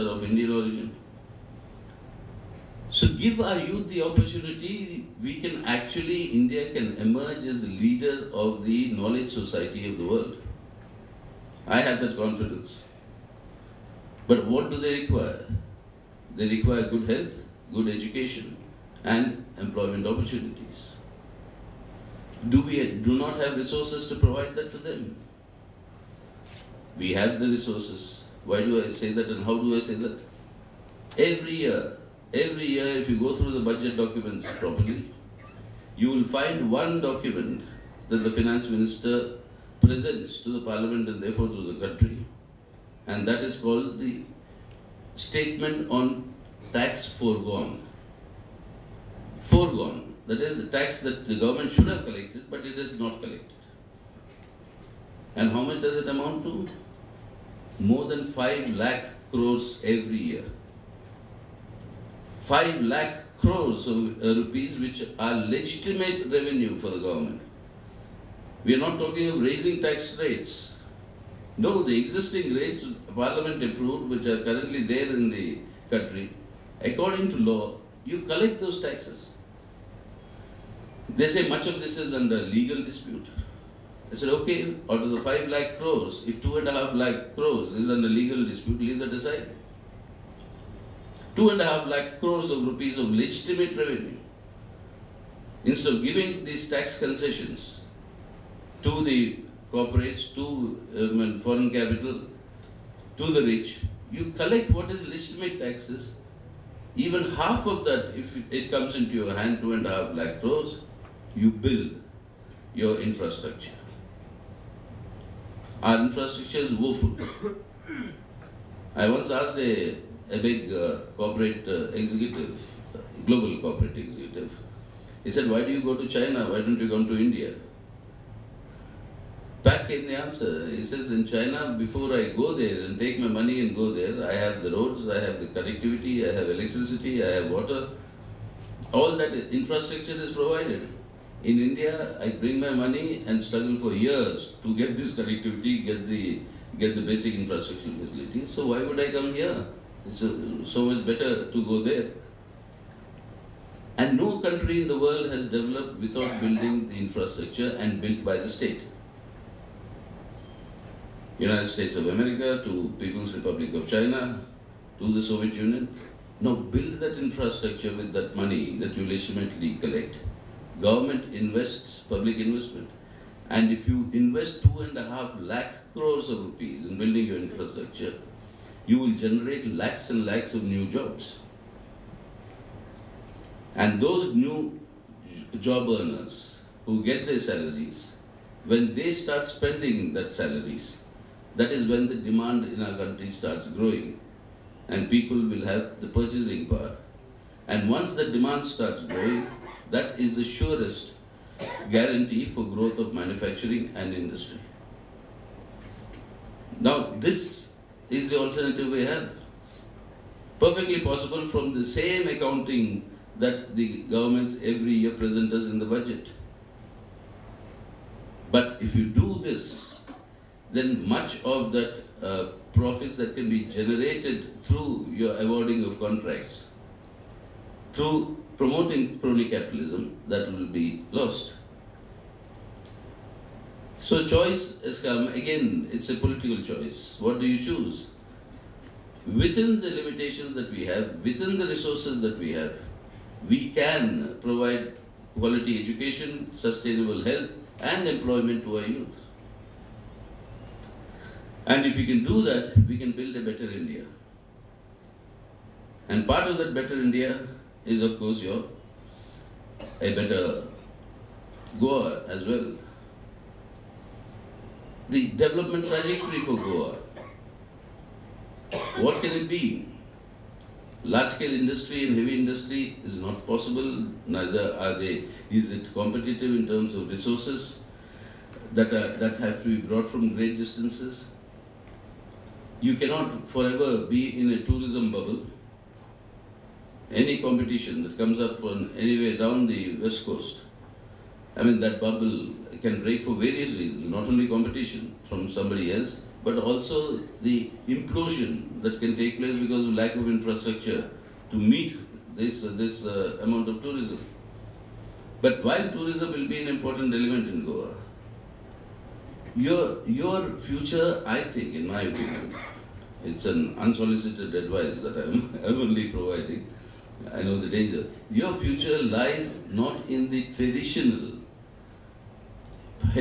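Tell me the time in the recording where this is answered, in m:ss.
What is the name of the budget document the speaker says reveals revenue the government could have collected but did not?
0:45.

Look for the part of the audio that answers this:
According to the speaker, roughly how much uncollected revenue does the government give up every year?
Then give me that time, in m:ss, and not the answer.
0:57.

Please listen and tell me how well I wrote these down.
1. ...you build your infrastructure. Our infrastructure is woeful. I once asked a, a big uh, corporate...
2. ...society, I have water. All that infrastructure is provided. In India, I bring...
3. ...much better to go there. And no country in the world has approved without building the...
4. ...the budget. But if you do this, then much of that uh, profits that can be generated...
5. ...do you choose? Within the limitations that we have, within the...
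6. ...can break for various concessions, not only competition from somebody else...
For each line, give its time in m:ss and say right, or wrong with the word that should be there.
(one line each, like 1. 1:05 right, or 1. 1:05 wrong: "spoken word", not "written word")
1. 1:51 right
2. 2:16 wrong: "electricity", not "society"
3. 2:30 wrong: "developed", not "approved"
4. 3:35 right
5. 3:57 right
6. 4:52 wrong: "reasons", not "concessions".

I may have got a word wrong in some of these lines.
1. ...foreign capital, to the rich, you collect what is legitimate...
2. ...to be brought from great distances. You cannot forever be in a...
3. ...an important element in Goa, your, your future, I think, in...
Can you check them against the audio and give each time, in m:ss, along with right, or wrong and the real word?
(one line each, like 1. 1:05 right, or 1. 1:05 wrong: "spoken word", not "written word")
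1. 1:41 right
2. 4:39 right
3. 5:06 right.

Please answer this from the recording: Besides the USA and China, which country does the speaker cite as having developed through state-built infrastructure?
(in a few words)
Soviet Union.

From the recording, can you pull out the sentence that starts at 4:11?
And if we can do that, we can build a better India.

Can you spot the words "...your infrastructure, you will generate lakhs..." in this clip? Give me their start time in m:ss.
2:57.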